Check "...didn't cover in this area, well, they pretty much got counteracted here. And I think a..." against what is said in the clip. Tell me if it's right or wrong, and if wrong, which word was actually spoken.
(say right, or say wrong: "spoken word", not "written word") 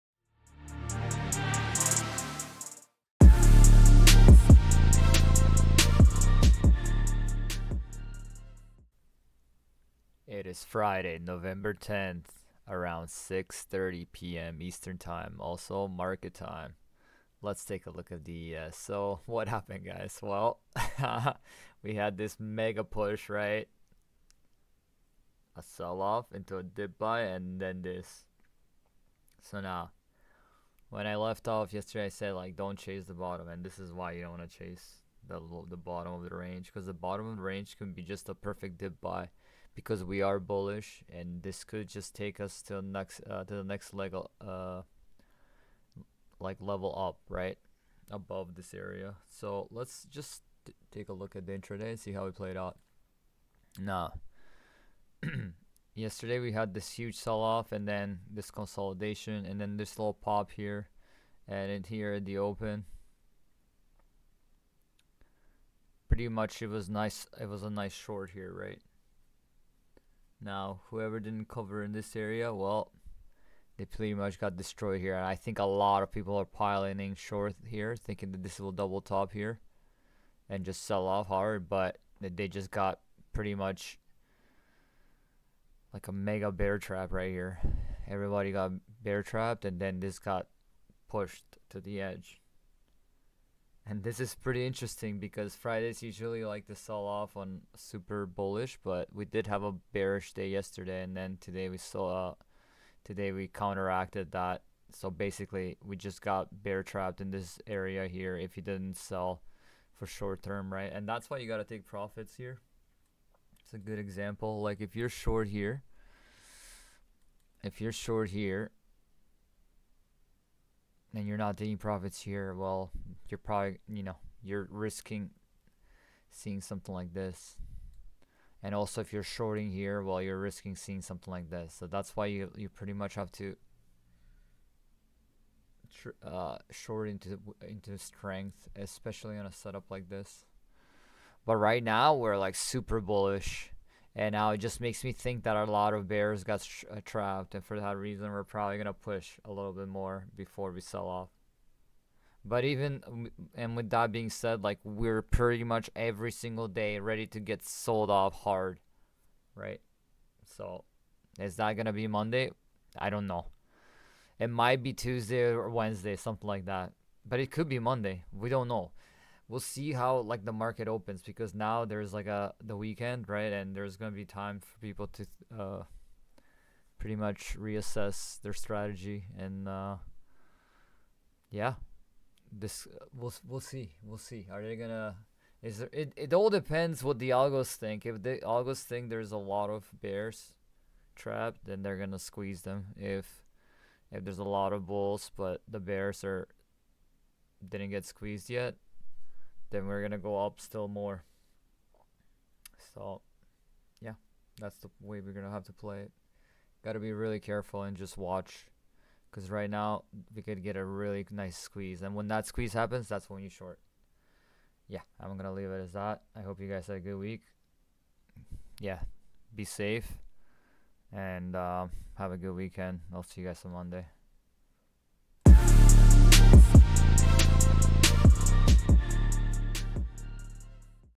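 wrong: "destroyed", not "counteracted".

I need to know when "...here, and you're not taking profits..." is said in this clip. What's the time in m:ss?
1:58.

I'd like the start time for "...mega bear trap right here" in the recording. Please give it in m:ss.
1:26.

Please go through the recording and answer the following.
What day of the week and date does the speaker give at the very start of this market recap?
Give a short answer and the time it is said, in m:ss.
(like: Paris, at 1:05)
Friday, November 10th, at 0:10.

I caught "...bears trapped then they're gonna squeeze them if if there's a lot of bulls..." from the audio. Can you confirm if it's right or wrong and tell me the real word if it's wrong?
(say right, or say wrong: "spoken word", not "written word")
right.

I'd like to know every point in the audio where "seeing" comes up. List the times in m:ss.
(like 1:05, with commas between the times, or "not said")
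2:06, 2:10.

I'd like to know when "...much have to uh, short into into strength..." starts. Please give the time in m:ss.
2:12.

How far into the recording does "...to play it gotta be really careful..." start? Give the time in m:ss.
3:25.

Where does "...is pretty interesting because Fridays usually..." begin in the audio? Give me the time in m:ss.
1:34.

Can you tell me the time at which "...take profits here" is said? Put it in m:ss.
1:51.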